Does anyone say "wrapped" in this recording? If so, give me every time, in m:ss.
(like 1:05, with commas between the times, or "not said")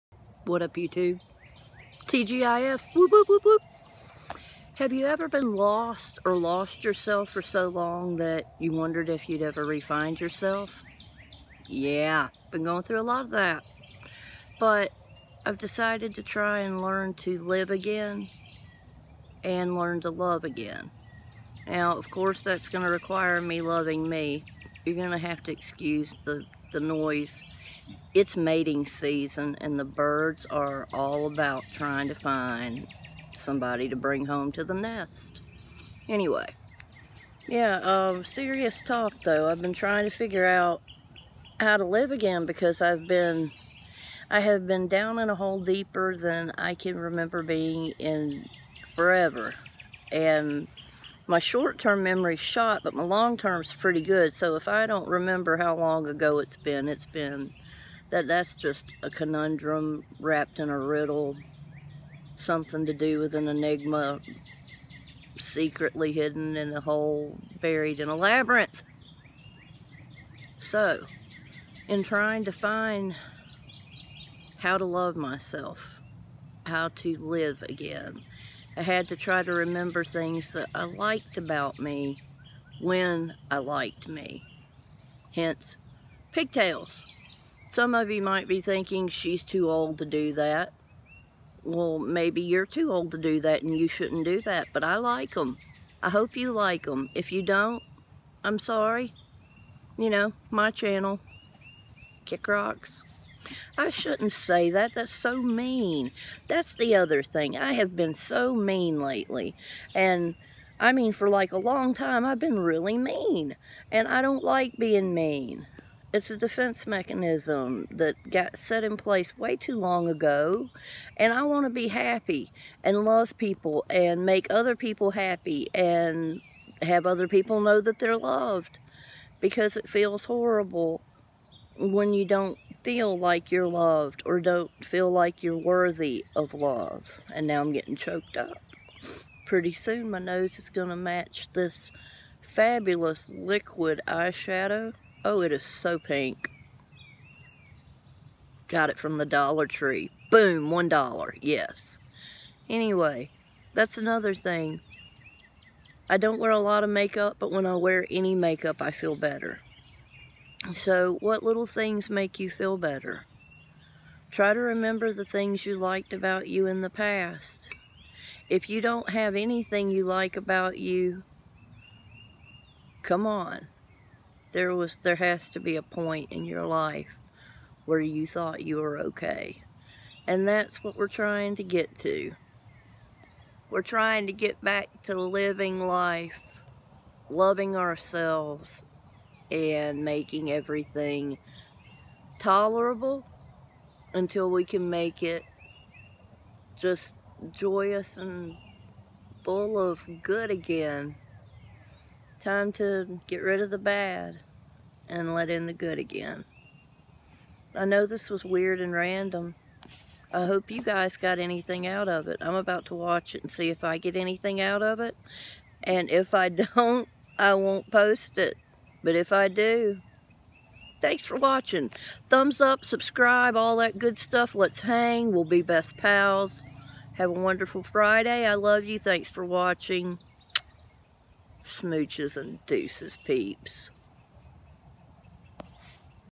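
1:00.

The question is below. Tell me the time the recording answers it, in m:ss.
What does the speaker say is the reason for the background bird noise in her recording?
0:28.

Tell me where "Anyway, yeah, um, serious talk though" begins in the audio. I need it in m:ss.
0:36.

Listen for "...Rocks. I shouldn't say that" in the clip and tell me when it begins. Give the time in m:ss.
1:42.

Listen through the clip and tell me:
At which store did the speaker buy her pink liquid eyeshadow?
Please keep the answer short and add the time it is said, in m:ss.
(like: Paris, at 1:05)
Dollar Tree, at 2:29.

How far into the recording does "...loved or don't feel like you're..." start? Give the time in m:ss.
2:13.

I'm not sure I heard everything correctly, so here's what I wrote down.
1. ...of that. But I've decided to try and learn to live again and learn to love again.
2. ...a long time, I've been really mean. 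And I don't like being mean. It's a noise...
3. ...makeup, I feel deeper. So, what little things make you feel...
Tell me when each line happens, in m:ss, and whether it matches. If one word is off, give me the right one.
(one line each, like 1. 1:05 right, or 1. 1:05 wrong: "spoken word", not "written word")
1. 0:13 right
2. 1:51 wrong: "defense", not "noise"
3. 2:38 wrong: "better", not "deeper".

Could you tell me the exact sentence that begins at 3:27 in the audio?
I know this was weird and random.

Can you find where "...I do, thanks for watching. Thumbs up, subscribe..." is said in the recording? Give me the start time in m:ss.
3:39.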